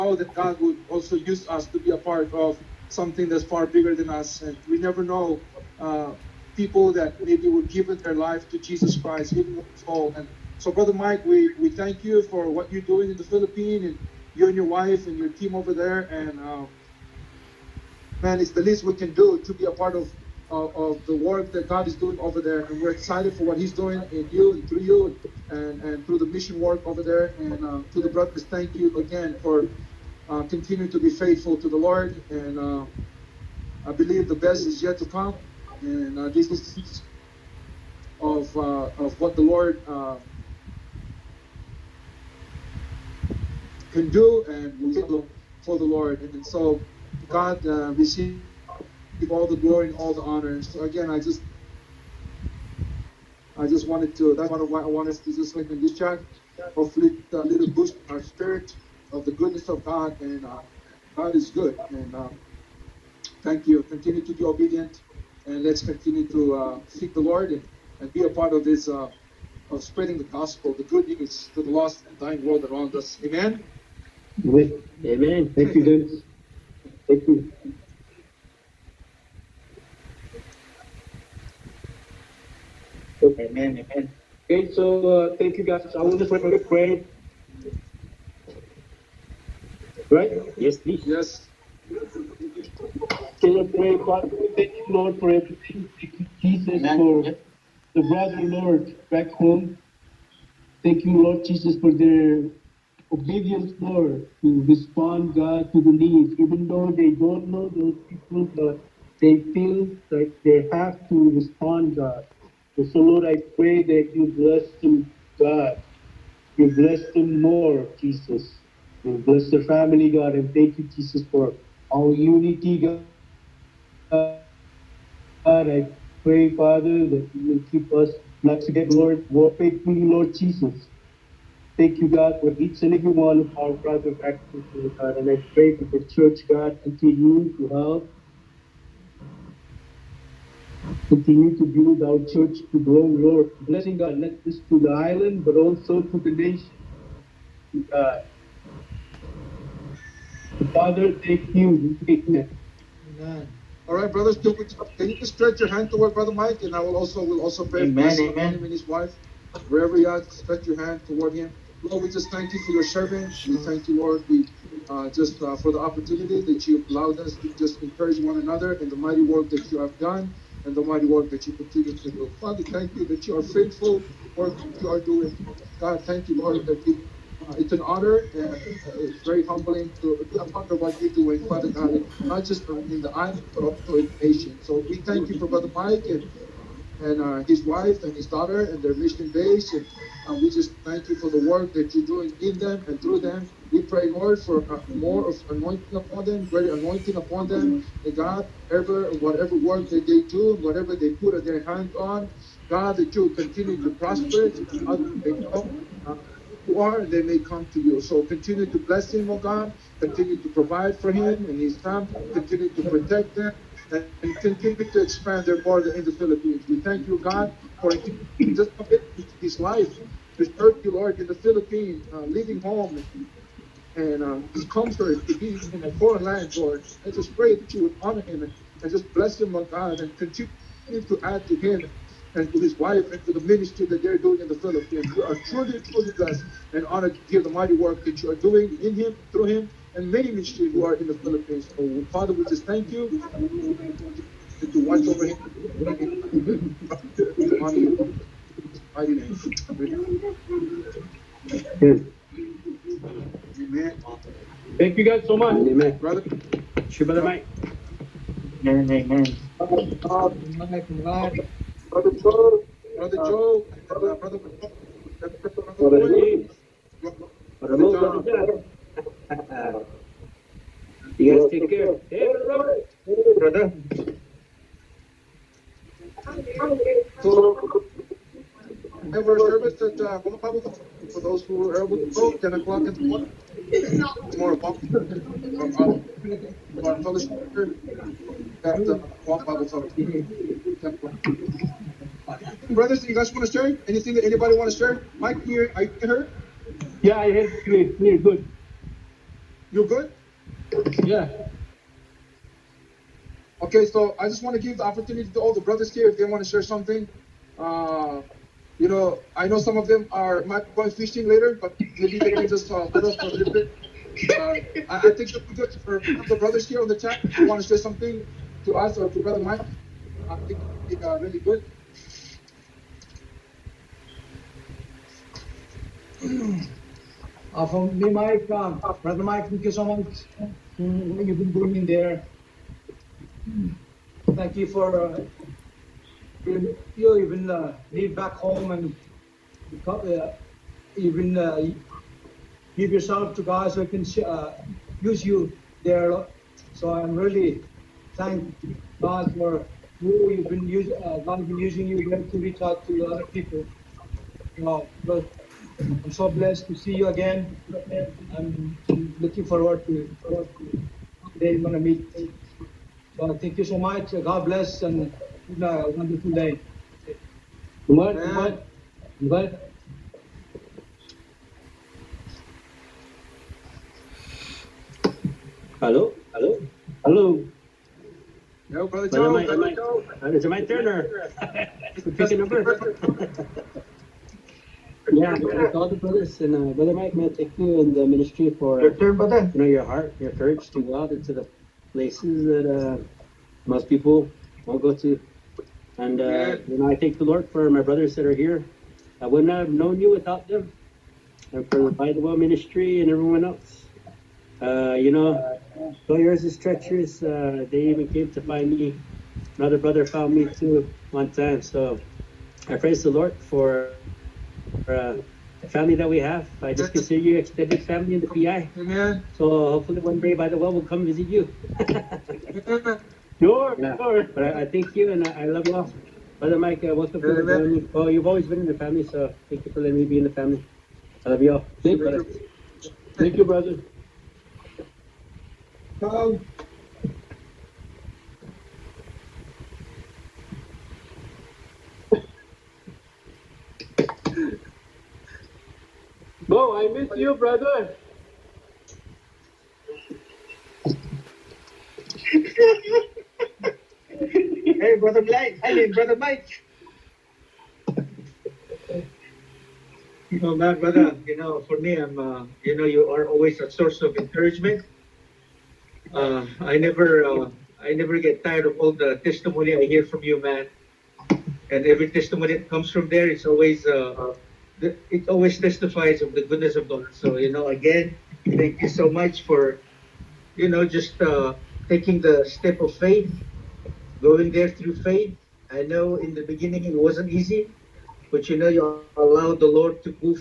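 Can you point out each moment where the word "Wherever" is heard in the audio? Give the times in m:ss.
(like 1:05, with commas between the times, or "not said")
2:39.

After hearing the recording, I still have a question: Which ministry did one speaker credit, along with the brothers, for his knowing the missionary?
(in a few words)
Bible ministry.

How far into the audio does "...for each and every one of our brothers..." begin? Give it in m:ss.
2:12.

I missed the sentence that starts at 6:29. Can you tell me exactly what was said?
You know your heart, your courage to go out into the places that uh, most people won't go to.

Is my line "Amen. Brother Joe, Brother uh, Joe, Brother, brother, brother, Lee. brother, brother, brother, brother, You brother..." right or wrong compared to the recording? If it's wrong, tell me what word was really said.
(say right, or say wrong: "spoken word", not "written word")
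right.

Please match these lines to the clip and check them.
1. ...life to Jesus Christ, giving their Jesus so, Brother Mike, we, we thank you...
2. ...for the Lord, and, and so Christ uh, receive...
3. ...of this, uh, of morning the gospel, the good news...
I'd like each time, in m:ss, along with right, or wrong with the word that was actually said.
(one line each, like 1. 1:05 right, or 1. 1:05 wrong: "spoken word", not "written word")
1. 0:08 wrong: "And", not "Jesus"
2. 0:45 wrong: "God", not "Christ"
3. 1:08 wrong: "spreading", not "morning".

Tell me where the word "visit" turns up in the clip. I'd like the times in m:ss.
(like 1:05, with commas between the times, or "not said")
7:01.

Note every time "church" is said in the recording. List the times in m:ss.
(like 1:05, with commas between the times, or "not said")
2:16, 2:22.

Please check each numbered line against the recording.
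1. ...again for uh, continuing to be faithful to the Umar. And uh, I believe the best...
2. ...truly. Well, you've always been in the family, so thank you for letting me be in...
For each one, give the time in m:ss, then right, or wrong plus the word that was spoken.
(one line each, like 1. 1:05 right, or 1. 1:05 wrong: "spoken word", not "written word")
1. 0:28 wrong: "Lord", not "Umar"
2. 7:07 wrong: "family", not "truly".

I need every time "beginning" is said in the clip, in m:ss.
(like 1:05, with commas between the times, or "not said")
8:06.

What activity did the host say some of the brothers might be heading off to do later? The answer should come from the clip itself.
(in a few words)
Fishing.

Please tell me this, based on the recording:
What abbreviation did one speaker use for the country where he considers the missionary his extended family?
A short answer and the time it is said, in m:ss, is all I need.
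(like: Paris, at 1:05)
PI, at 6:58.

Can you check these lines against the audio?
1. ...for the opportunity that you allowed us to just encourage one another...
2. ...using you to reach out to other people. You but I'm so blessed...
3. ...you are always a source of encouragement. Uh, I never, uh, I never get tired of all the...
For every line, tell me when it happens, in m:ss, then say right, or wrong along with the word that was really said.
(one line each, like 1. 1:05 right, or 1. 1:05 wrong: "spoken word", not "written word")
1. 2:45 right
2. 5:51 right
3. 7:42 right.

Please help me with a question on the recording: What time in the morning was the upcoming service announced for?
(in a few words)
10 o'clock.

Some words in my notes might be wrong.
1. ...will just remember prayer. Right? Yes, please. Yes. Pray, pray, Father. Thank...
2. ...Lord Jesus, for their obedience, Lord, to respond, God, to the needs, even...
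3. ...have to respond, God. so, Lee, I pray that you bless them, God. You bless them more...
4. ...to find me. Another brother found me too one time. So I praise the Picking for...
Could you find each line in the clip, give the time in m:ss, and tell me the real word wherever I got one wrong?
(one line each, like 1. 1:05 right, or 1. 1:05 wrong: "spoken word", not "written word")
1. 1:26 right
2. 1:41 right
3. 1:50 wrong: "Lord", not "Lee"
4. 6:48 wrong: "Lord", not "Picking".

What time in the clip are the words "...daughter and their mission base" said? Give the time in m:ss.
3:08.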